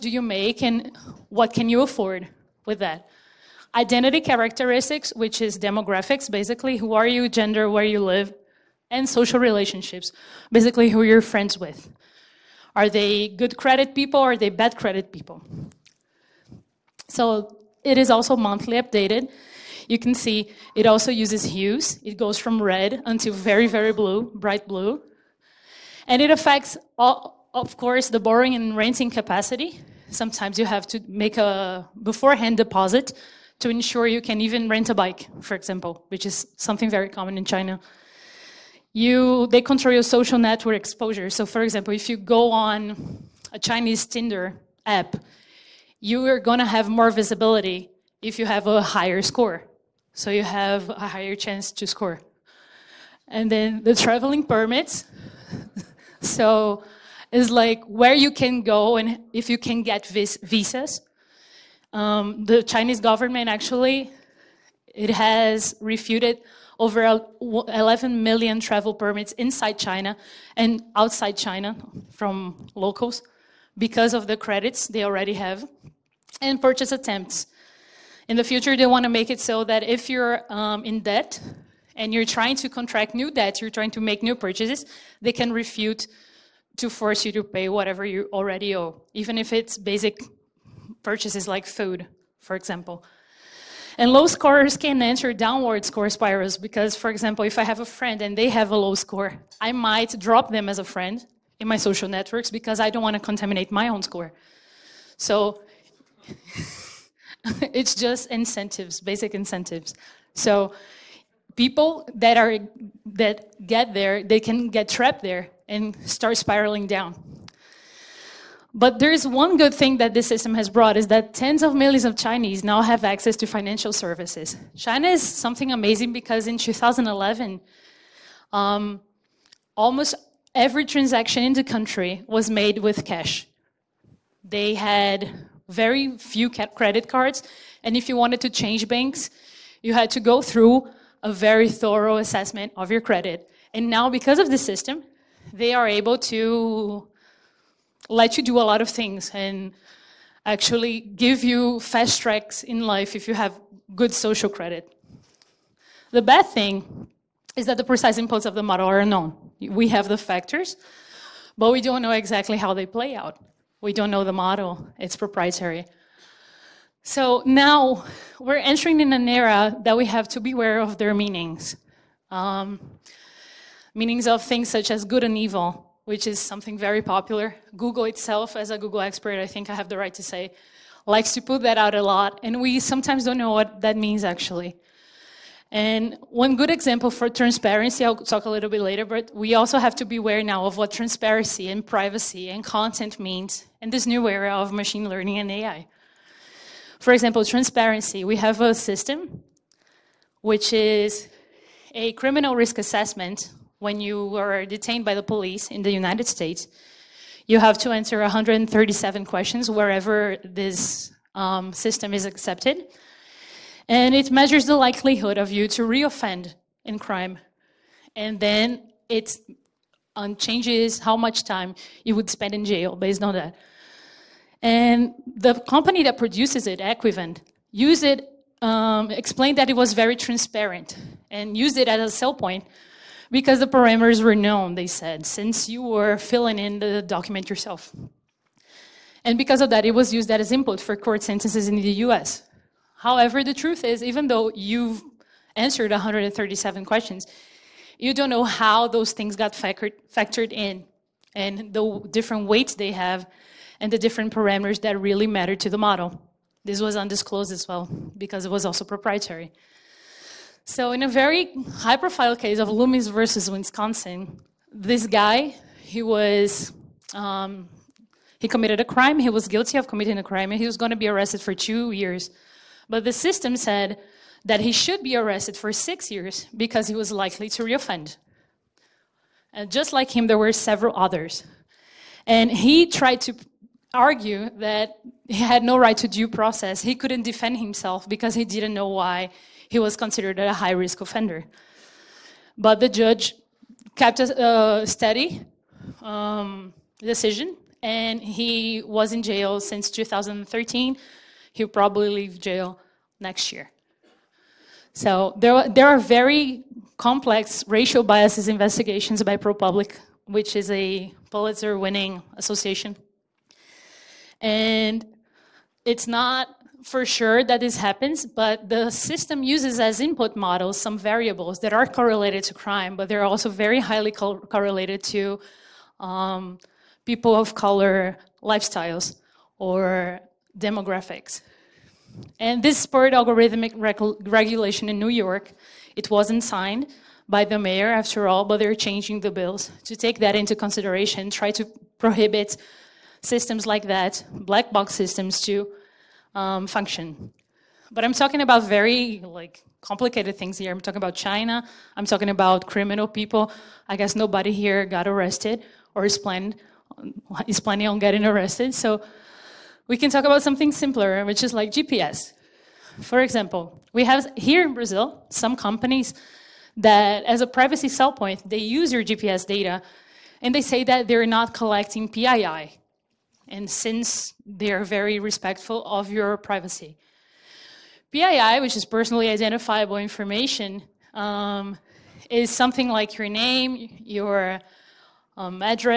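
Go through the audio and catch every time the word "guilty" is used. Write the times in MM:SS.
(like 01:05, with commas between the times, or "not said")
04:29.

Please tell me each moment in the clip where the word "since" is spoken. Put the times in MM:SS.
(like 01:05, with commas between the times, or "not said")
03:55, 04:59, 06:13.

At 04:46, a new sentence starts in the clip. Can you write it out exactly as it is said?
He couldn't defend himself because he didn't know why he was considered a high risk offender.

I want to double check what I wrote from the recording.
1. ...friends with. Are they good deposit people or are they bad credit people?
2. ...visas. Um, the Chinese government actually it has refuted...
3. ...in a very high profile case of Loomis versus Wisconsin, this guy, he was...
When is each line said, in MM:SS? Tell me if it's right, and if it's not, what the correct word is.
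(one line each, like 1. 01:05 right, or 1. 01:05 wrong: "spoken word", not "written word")
1. 00:11 wrong: "credit", not "deposit"
2. 01:00 right
3. 04:20 right.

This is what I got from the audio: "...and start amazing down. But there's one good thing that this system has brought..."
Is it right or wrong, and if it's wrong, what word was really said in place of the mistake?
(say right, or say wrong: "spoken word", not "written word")
wrong: "spiraling", not "amazing".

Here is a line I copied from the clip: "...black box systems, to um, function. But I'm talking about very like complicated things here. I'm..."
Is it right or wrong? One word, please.
right.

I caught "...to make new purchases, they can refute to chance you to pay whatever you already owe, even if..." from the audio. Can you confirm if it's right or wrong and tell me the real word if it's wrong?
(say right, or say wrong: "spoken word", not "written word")
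wrong: "force", not "chance".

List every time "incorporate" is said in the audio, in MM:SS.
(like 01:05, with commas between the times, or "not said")
not said.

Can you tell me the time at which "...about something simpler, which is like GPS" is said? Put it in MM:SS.
06:00.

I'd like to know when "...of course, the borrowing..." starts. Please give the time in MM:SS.
00:27.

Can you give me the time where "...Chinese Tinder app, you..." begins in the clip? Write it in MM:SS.
00:43.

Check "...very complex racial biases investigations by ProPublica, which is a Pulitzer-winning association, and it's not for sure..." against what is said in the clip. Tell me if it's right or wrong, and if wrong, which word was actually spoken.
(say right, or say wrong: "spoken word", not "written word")
right.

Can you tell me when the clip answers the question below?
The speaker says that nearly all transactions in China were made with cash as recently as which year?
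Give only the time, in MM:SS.
02:06.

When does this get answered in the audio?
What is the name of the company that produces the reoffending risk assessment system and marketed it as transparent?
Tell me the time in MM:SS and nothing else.
03:46.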